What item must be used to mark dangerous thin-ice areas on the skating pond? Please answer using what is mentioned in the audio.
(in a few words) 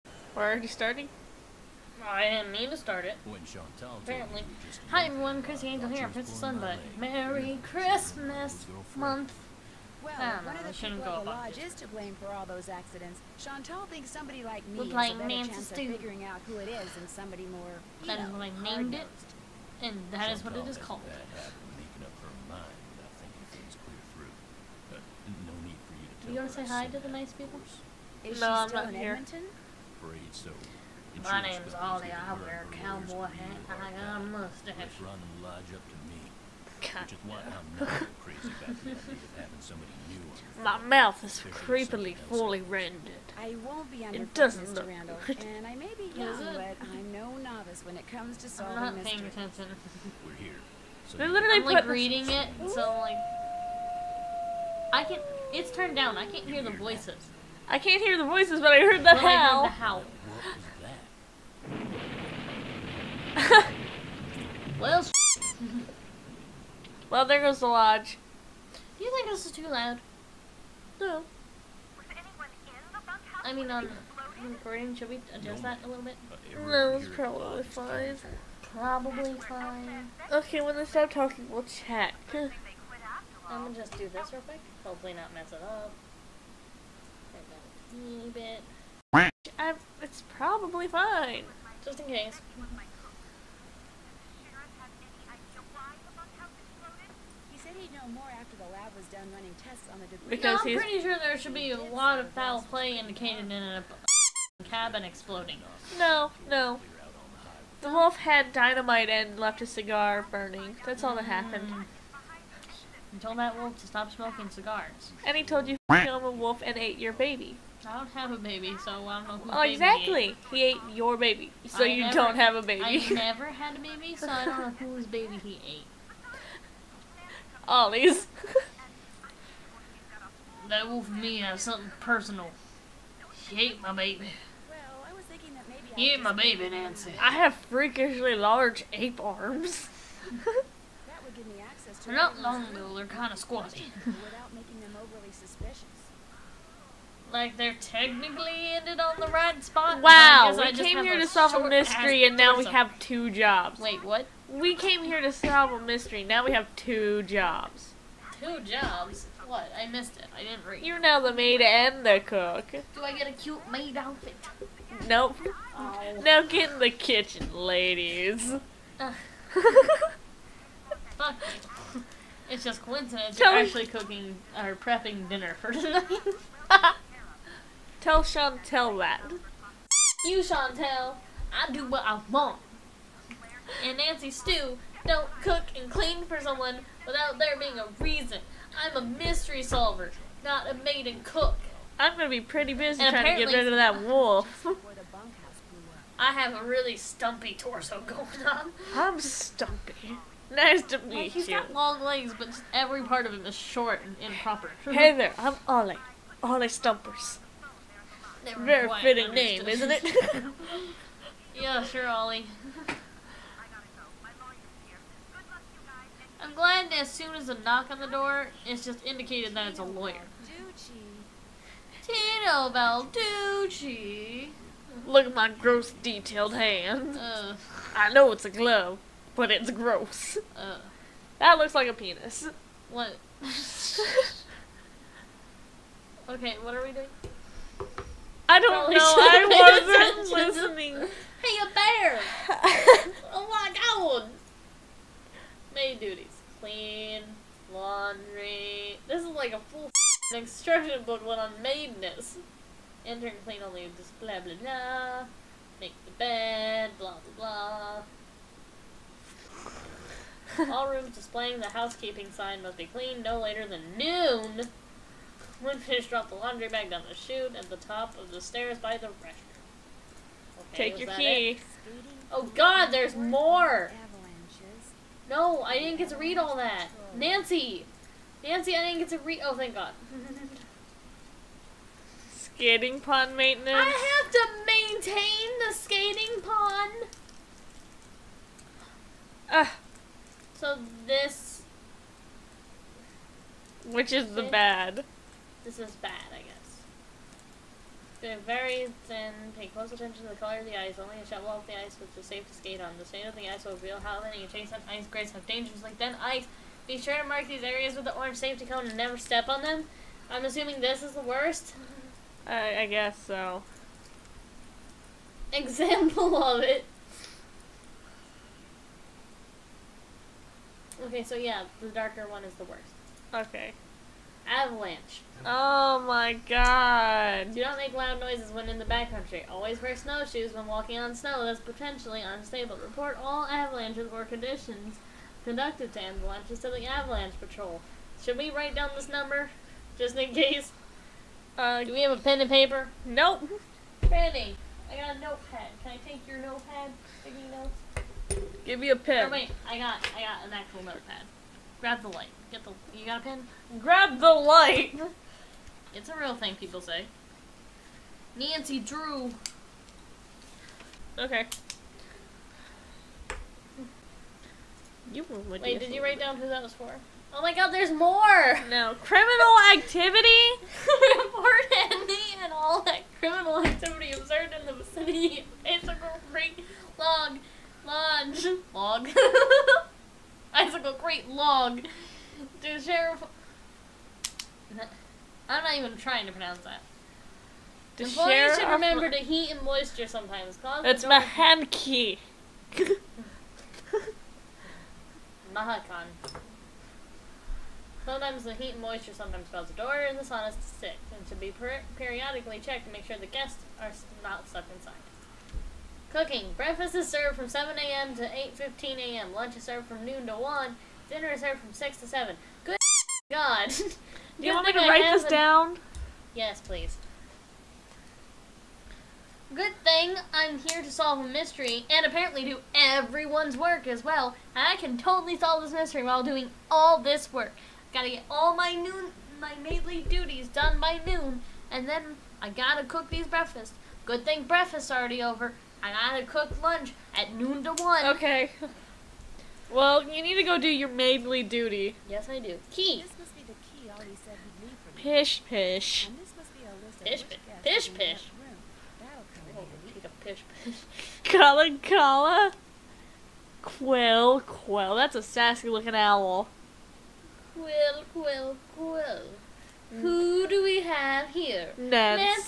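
Orange safety cone.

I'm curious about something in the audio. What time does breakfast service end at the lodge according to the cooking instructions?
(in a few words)
8:15 a.m.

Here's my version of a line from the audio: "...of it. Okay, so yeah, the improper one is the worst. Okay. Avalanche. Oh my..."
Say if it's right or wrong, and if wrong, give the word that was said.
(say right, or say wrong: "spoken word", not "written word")
wrong: "darker", not "improper".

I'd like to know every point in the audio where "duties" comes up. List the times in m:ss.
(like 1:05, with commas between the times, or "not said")
4:06, 7:10.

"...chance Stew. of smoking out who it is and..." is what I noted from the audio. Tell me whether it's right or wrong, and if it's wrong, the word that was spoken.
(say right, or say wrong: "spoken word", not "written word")
wrong: "figuring", not "smoking".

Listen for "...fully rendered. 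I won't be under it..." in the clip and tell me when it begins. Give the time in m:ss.
0:42.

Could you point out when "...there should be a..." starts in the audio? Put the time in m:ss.
1:41.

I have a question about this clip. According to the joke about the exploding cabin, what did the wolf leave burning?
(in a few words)
A cigar.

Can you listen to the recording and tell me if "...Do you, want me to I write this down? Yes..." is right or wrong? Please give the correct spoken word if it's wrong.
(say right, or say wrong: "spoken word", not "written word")
right.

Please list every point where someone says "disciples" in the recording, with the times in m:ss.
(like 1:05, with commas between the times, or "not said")
not said.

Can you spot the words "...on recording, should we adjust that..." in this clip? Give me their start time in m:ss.
1:13.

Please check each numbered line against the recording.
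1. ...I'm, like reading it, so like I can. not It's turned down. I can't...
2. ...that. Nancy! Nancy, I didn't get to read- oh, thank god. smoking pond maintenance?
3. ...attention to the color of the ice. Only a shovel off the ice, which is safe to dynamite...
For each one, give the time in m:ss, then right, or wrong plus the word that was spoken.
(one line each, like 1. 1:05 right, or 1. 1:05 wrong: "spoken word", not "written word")
1. 0:51 right
2. 4:36 wrong: "skating", not "smoking"
3. 4:59 wrong: "skate", not "dynamite".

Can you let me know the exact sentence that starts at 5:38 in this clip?
Should we write down this number?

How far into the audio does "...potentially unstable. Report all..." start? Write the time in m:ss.
5:31.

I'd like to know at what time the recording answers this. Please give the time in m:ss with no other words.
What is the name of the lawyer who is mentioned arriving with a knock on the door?
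3:42.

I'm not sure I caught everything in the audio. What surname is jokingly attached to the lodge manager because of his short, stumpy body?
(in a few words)
Stumpers.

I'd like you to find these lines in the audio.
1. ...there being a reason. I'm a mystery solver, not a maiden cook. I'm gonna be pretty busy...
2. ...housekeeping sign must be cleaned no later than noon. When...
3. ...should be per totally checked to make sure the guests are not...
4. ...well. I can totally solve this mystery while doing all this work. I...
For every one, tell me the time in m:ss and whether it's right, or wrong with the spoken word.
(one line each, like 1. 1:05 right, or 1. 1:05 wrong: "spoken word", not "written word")
1. 3:07 right
2. 4:21 right
3. 6:41 wrong: "periodically", not "totally"
4. 7:04 right.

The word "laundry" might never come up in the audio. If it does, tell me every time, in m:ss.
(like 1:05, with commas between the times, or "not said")
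4:07, 4:26.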